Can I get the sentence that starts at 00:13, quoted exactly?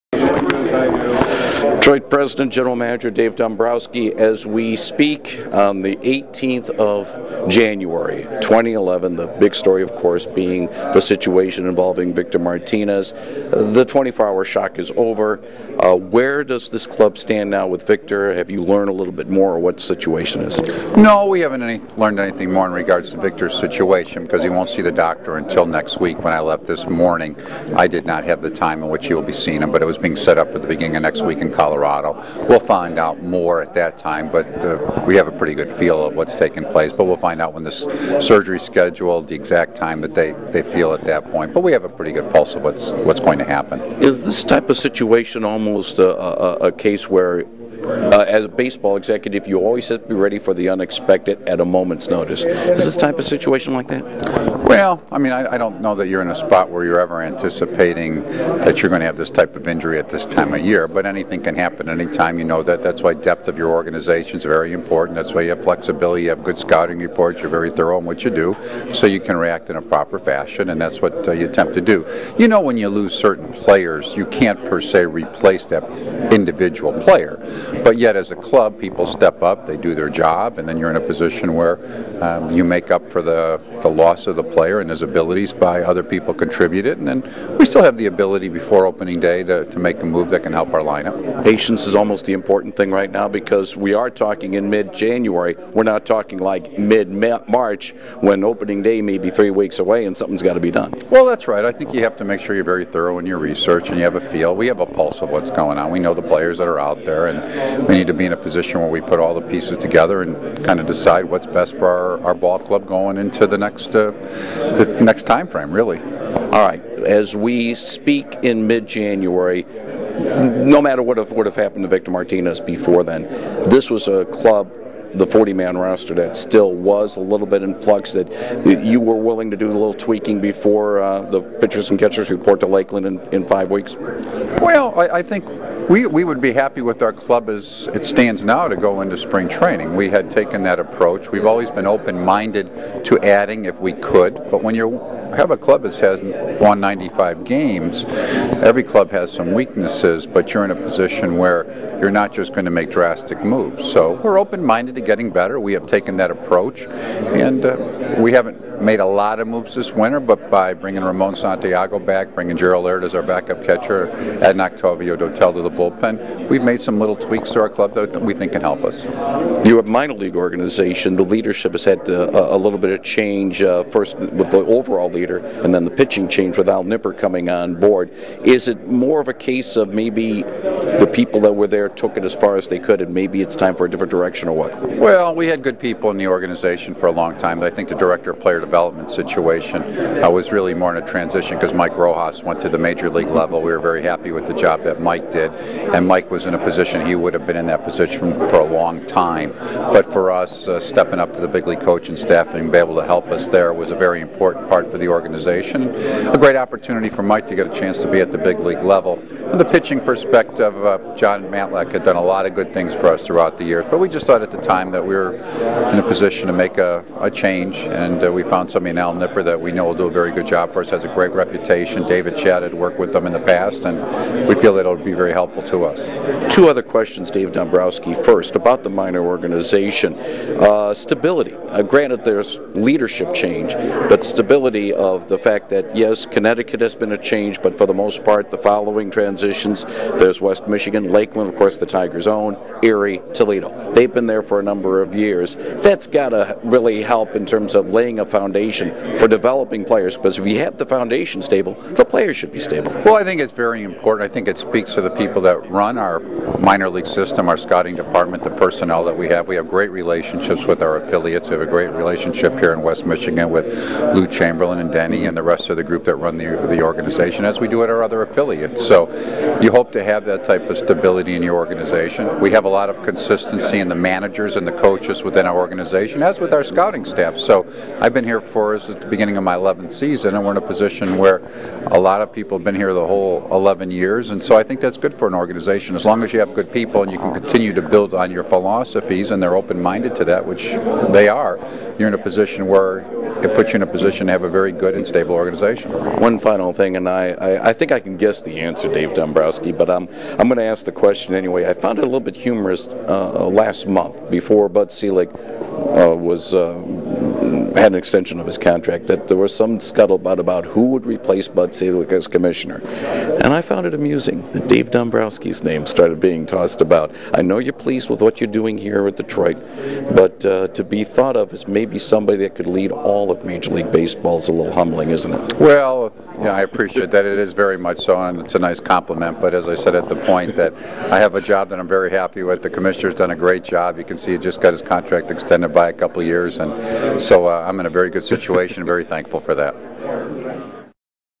The 24 hour shock is over.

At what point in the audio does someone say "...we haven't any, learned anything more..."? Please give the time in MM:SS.
00:21.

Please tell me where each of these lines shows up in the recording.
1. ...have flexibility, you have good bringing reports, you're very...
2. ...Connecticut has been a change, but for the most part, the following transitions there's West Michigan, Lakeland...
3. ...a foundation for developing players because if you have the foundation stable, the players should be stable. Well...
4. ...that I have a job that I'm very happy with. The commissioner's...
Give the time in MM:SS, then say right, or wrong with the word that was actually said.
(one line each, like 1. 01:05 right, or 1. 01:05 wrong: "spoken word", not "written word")
1. 01:05 wrong: "scouting", not "bringing"
2. 03:56 right
3. 04:08 right
4. 05:30 right.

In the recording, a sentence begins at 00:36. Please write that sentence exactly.
But we'll find out when the surgery scheduled, the exact time that they, they feel at that point.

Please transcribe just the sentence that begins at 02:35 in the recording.
We have taken that approach, and uh, we haven't made a lot of moves this winter.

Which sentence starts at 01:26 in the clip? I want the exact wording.
And then we still have the ability before opening day to, to make a move that can help our lineup.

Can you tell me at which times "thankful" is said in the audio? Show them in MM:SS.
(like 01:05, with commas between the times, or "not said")
05:39.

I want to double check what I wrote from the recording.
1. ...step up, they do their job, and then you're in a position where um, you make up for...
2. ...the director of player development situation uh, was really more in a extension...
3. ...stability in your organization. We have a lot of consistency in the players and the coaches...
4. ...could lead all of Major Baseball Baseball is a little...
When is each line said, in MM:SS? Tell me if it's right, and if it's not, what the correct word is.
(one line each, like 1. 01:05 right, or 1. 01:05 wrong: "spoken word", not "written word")
1. 01:19 right
2. 03:07 wrong: "transition", not "extension"
3. 04:30 wrong: "managers", not "players"
4. 05:22 wrong: "League", not "Baseball".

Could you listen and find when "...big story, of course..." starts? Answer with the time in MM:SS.
00:09.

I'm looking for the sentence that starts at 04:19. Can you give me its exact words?
We have great relationships with our affiliates.